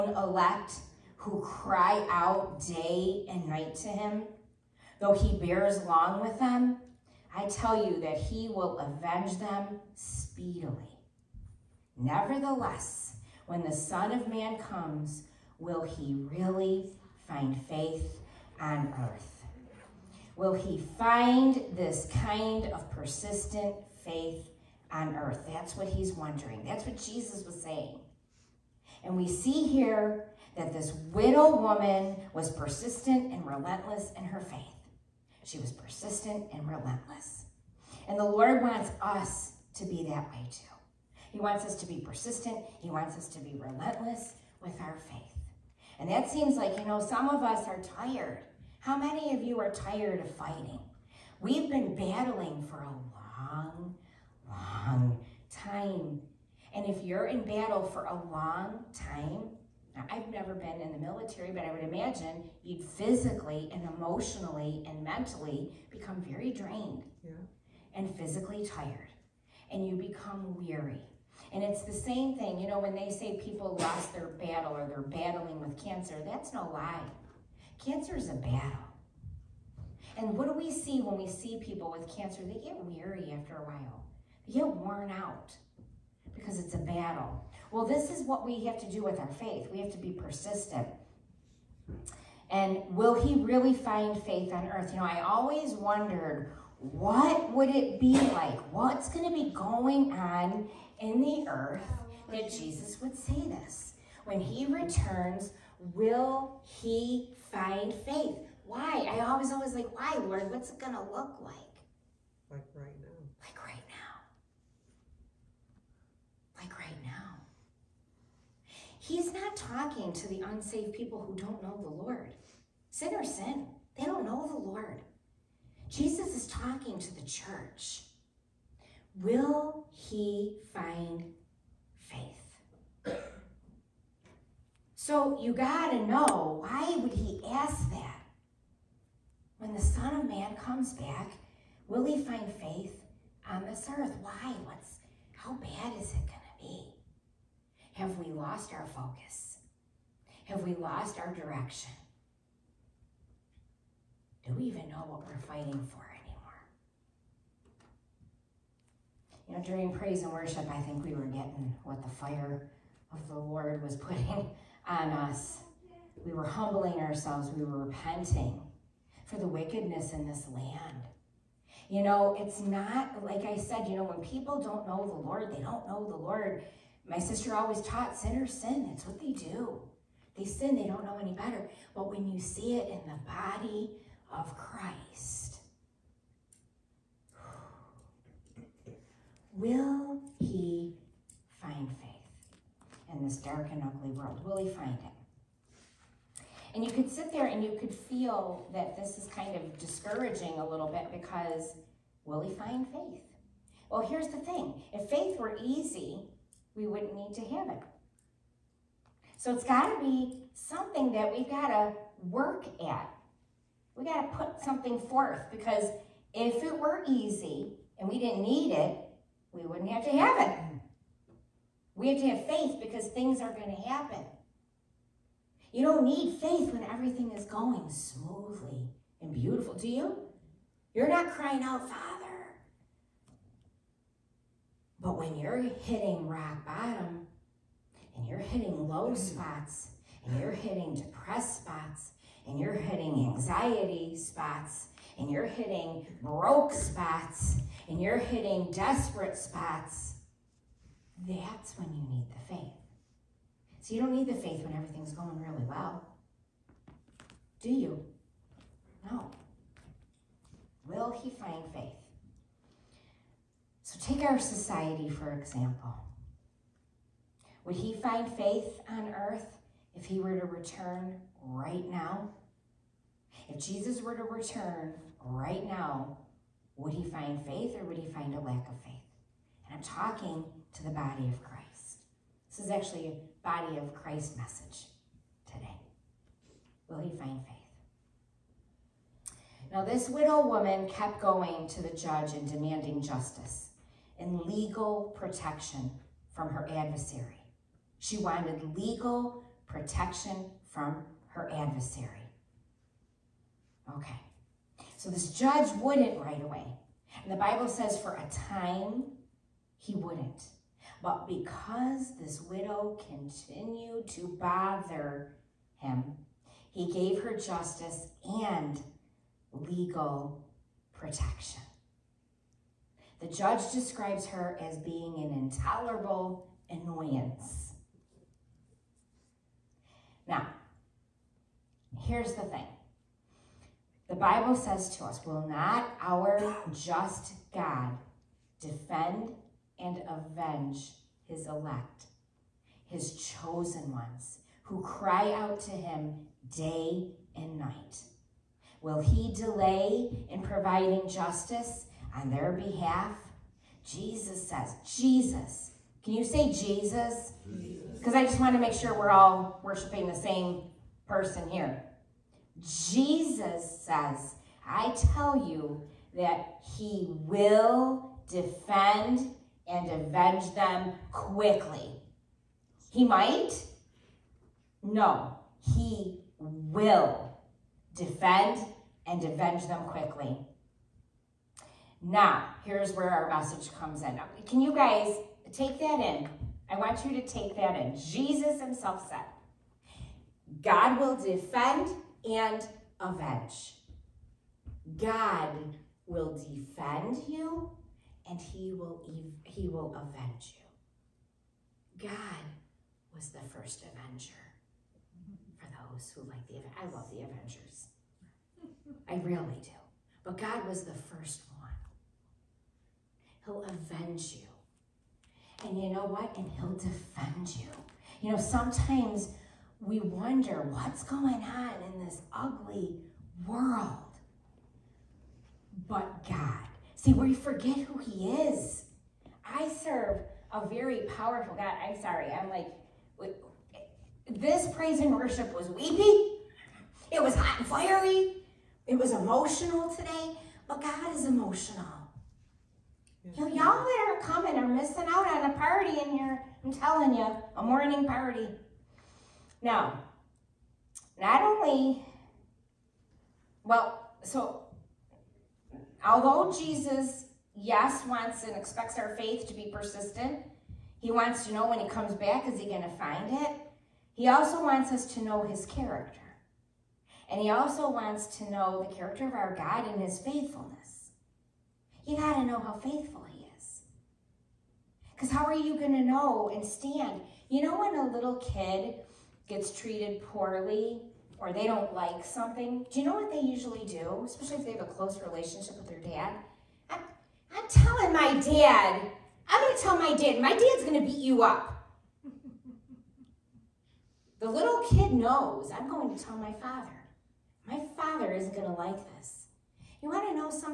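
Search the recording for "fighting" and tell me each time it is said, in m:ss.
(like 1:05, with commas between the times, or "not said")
0:50, 2:35.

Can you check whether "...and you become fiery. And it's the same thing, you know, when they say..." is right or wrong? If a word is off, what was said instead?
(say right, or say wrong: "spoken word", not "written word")
wrong: "weary", not "fiery".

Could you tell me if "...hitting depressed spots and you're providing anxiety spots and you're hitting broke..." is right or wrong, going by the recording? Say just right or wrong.
wrong.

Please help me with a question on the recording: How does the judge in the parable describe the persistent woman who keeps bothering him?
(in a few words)
An intolerable annoyance.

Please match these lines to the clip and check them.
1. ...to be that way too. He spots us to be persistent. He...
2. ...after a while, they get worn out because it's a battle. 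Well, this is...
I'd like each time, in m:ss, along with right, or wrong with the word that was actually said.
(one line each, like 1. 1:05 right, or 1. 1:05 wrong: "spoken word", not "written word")
1. 0:39 wrong: "wants", not "spots"
2. 1:23 right.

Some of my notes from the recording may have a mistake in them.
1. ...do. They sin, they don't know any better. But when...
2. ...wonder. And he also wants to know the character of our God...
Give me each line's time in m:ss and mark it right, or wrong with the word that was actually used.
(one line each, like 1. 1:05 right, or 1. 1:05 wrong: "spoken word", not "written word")
1. 2:59 right
2. 7:45 wrong: "character", not "wonder".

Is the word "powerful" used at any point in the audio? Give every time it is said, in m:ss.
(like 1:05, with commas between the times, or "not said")
7:11.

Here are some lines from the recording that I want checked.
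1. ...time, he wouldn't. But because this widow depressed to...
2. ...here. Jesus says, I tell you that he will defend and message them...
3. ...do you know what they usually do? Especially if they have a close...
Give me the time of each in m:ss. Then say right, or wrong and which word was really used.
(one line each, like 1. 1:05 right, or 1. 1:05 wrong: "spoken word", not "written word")
1. 5:08 wrong: "continued", not "depressed"
2. 6:01 wrong: "avenge", not "message"
3. 8:02 right.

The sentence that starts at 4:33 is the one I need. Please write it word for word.
If Jesus were to return right now, would he find faith or would he find a lack of faith?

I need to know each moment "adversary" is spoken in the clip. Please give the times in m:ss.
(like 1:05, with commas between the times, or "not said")
4:56, 5:01.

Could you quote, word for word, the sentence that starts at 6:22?
Now, here's where our message comes in.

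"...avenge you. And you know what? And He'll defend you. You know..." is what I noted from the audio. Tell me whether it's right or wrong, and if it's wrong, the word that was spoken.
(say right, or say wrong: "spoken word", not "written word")
right.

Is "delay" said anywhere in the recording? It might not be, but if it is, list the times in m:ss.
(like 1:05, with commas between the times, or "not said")
5:49.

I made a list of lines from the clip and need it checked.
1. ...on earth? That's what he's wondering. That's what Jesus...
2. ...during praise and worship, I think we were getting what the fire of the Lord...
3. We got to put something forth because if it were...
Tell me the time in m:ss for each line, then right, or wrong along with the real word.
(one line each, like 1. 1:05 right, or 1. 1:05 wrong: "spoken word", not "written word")
1. 0:24 right
2. 2:39 right
3. 3:33 right.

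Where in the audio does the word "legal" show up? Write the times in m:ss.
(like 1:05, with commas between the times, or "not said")
4:54, 4:58, 5:19.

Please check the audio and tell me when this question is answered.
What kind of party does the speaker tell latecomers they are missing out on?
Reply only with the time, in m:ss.
7:27.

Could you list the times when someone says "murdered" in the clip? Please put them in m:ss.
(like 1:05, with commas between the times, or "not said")
not said.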